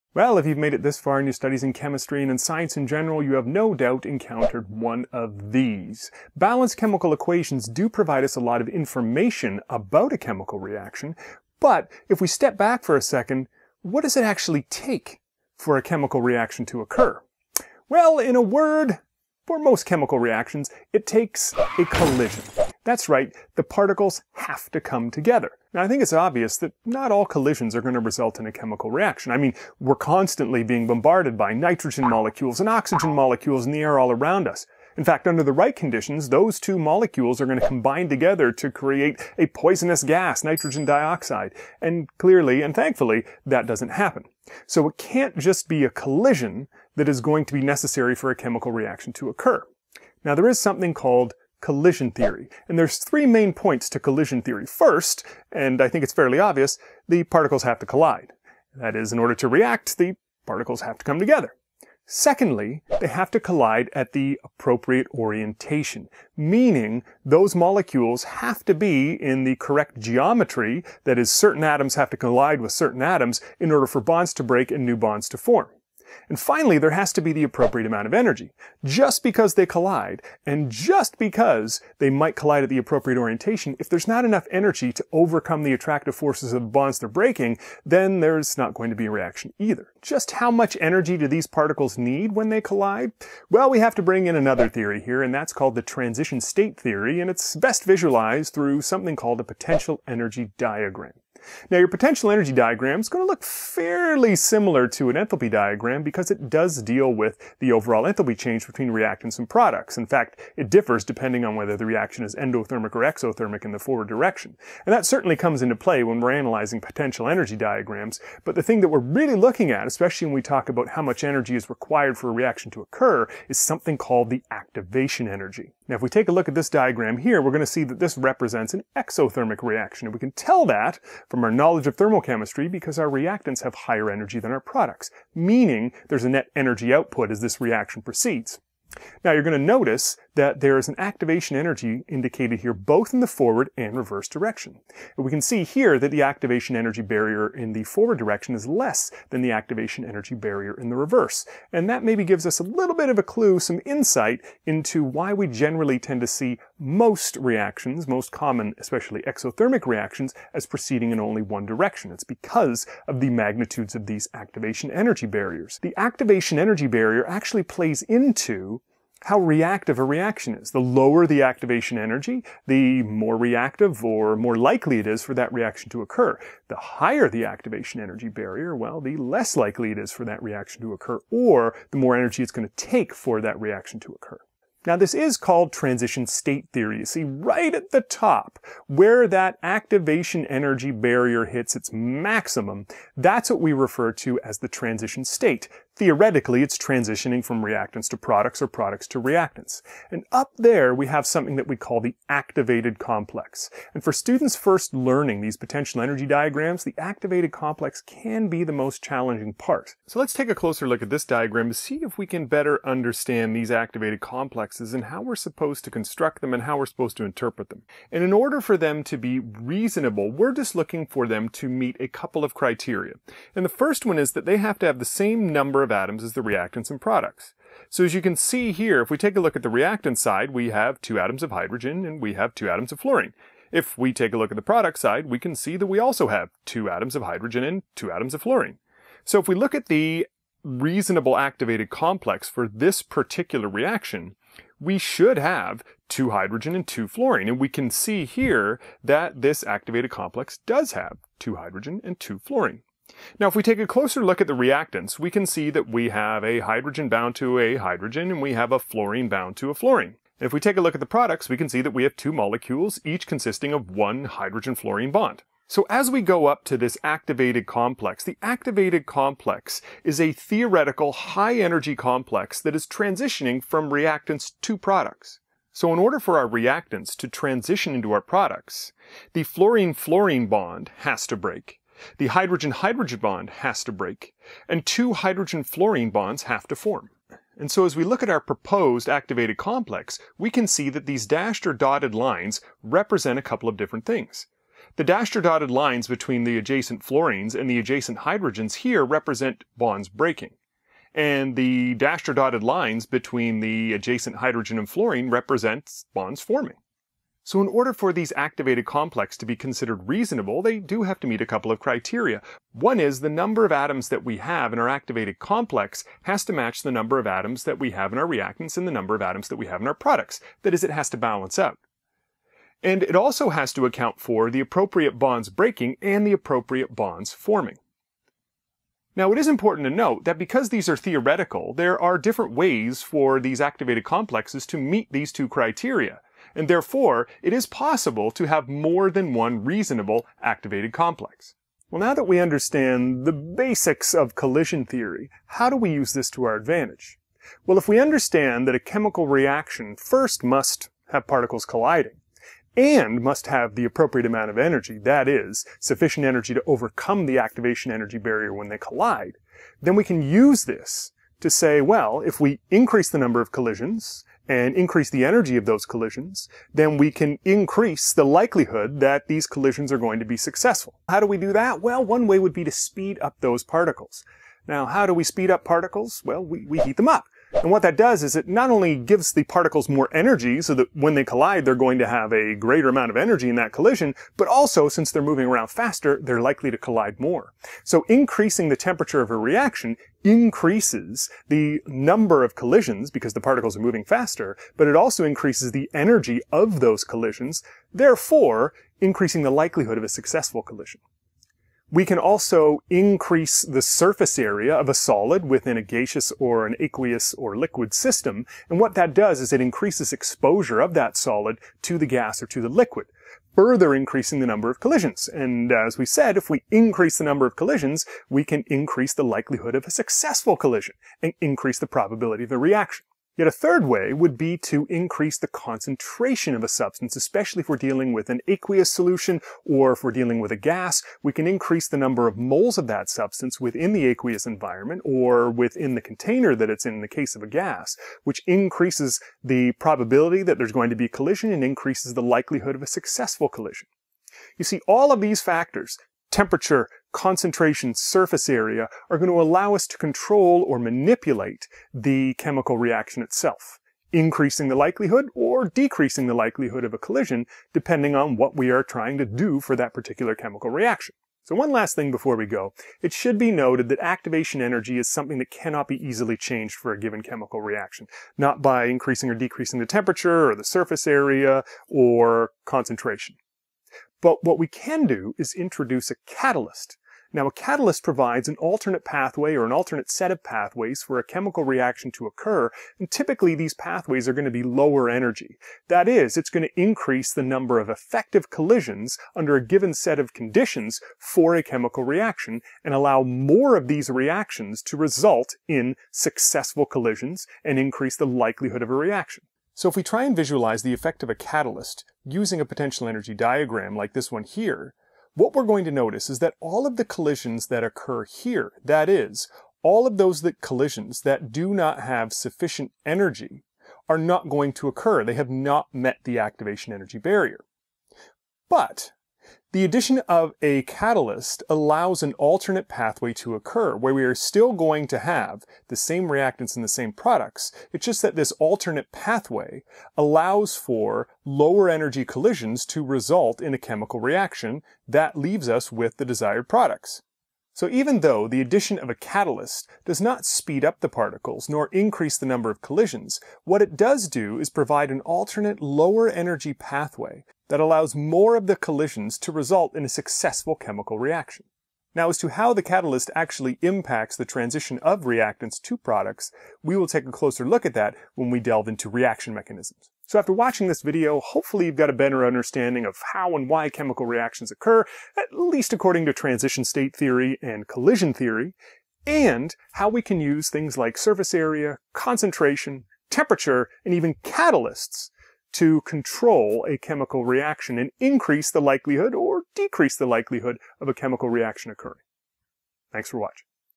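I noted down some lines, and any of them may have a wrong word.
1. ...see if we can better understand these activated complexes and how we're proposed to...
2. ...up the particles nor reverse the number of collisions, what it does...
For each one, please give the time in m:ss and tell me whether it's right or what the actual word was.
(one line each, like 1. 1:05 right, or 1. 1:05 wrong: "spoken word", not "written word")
1. 3:31 wrong: "supposed", not "proposed"
2. 9:00 wrong: "increase", not "reverse".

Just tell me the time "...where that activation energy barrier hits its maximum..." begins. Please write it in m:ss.
3:08.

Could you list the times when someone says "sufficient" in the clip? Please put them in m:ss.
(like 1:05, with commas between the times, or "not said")
5:55, 8:32.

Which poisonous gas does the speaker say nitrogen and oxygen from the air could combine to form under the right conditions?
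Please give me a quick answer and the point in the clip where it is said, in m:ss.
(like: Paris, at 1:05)
nitrogen dioxide, at 0:40.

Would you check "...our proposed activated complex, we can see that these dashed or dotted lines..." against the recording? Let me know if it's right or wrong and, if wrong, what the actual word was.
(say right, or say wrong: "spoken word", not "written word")
right.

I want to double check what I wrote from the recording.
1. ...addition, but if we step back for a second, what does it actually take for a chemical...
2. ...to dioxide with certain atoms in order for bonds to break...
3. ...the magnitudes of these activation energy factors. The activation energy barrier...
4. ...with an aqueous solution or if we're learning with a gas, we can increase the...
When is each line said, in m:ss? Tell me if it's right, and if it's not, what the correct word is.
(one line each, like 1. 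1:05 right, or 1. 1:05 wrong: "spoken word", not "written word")
1. 0:10 wrong: "reaction", not "addition"
2. 1:12 wrong: "collide", not "dioxide"
3. 2:43 wrong: "barriers", not "factors"
4. 7:08 wrong: "dealing", not "learning".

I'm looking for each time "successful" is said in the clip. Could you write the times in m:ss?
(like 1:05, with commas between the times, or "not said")
6:10, 6:40, 6:59, 7:22, 8:16, 9:10.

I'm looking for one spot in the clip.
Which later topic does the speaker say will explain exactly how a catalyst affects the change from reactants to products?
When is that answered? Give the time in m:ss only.
9:19.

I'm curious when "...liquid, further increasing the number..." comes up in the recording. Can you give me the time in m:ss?
6:52.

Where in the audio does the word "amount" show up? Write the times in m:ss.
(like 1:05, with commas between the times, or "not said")
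1:17, 5:54, 6:22.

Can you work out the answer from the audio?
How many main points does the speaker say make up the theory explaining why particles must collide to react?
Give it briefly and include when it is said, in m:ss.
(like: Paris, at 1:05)
3, at 0:52.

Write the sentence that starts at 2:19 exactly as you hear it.
Now, you're going to notice that there is an activation energy indicated here both in the forward and reverse direction.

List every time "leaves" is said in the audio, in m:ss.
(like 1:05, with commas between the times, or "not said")
8:55.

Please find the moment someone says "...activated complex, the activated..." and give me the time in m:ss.
4:27.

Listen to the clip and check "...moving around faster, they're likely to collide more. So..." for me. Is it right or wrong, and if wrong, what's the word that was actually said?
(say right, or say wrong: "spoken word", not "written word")
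right.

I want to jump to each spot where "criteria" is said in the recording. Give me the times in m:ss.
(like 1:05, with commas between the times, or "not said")
3:42, 5:11, 5:35.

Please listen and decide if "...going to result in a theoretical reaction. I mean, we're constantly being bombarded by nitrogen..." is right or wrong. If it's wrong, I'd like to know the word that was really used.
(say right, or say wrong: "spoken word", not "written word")
wrong: "chemical", not "theoretical".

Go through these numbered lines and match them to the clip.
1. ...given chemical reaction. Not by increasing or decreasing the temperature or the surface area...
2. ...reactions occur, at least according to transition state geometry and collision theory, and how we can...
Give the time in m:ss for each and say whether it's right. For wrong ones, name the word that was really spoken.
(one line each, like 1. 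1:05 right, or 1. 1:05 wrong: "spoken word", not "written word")
1. 7:46 right
2. 9:24 wrong: "theory", not "geometry".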